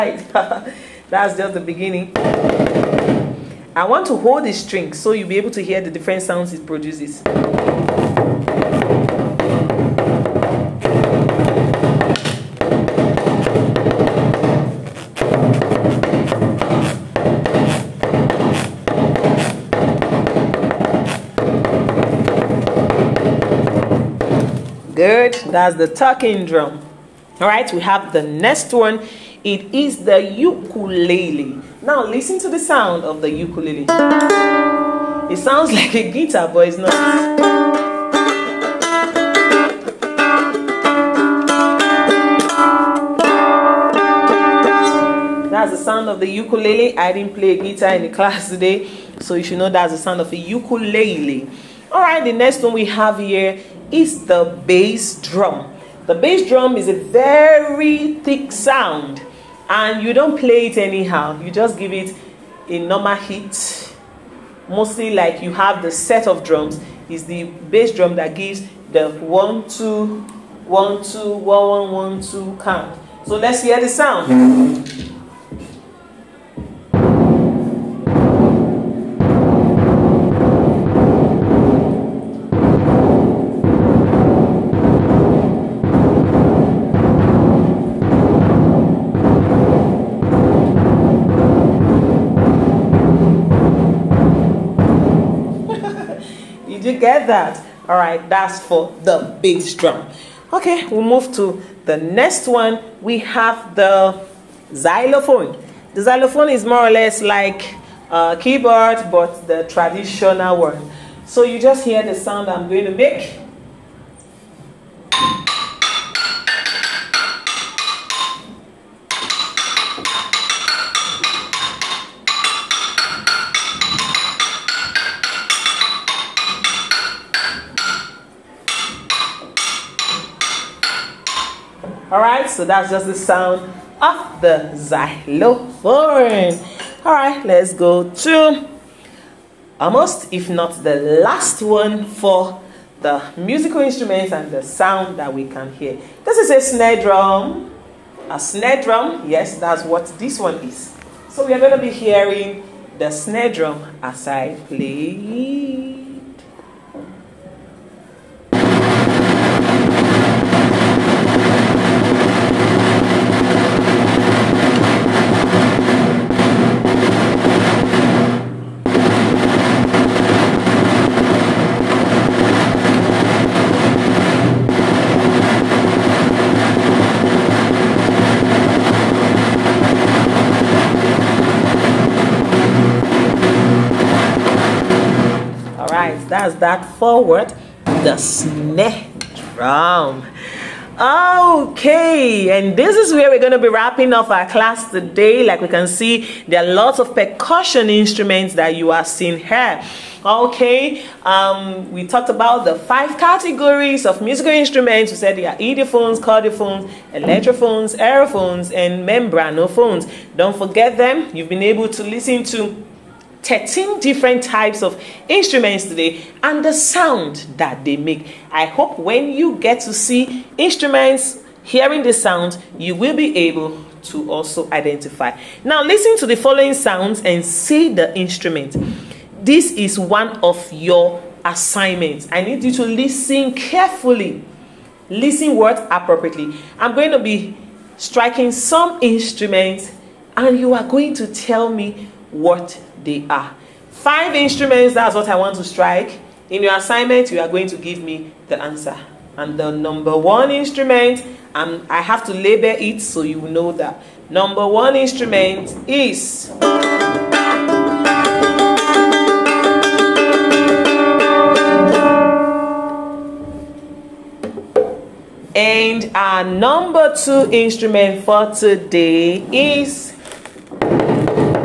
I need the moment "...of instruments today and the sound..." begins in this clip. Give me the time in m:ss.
3:34.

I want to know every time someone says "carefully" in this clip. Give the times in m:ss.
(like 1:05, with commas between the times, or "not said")
3:53.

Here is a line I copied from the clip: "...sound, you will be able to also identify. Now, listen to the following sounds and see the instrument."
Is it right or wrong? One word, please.
right.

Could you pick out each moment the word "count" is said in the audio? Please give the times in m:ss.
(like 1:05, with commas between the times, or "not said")
1:12.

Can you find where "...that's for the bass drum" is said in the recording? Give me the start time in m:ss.
1:38.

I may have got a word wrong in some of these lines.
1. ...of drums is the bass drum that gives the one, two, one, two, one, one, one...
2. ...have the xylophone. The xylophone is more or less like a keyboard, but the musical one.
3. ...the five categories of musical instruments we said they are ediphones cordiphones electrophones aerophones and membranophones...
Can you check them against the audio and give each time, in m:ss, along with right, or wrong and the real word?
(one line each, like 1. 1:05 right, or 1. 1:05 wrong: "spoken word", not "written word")
1. 1:06 right
2. 1:43 wrong: "traditional", not "musical"
3. 3:22 right.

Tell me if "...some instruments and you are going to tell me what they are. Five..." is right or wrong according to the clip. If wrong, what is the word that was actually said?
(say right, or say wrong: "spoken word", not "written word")
right.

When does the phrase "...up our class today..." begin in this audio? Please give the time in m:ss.
3:14.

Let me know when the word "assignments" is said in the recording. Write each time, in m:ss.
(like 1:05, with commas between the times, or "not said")
3:51, 4:06.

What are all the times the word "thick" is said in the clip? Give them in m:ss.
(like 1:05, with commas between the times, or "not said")
0:58.